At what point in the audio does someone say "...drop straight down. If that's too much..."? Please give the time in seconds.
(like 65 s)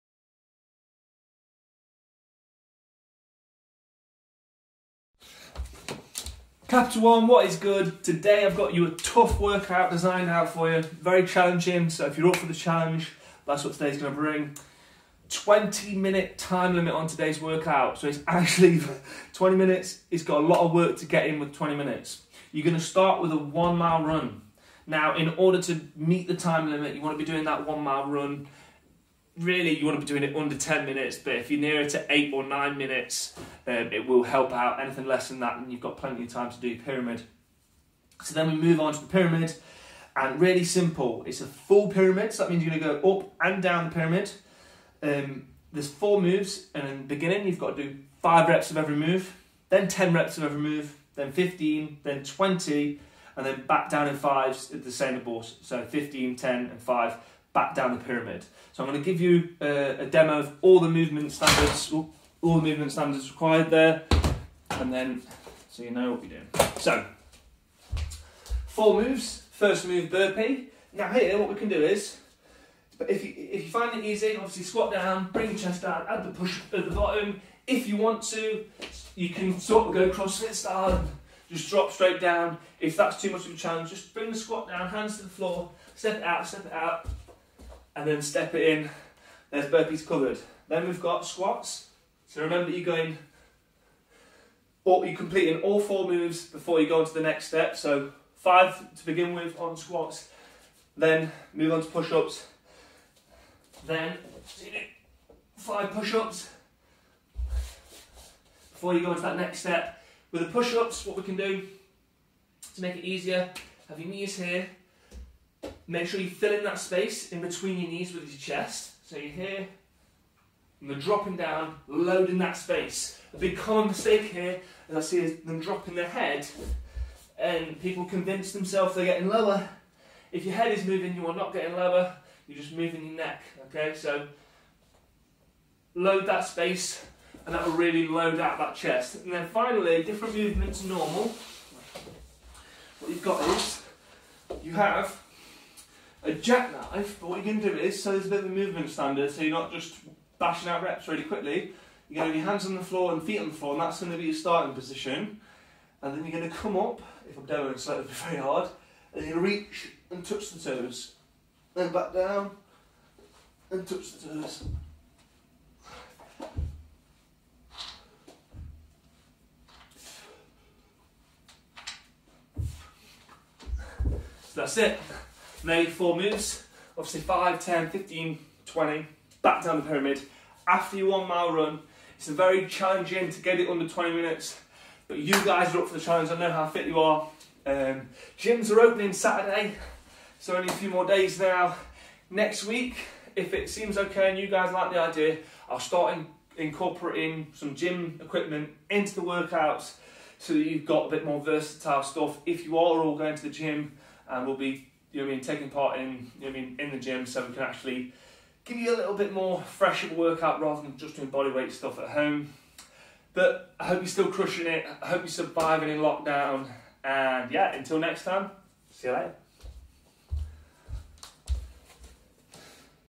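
81 s.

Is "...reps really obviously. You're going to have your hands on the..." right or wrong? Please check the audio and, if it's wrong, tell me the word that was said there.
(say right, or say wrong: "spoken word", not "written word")
wrong: "quickly", not "obviously".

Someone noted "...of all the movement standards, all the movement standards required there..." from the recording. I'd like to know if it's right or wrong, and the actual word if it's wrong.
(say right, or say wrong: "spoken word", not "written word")
right.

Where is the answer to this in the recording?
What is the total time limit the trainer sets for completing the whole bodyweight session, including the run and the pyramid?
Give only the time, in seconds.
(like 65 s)
15 s.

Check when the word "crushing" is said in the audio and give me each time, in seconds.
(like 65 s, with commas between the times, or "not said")
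214 s.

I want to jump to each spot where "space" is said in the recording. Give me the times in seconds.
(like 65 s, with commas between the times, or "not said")
116 s, 122 s, 136 s.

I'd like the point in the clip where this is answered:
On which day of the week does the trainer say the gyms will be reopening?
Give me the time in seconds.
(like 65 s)
189 s.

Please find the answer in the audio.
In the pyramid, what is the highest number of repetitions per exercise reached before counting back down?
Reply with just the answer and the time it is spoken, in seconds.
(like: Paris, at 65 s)
20, at 52 s.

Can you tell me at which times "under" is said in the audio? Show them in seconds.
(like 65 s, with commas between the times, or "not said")
30 s, 183 s.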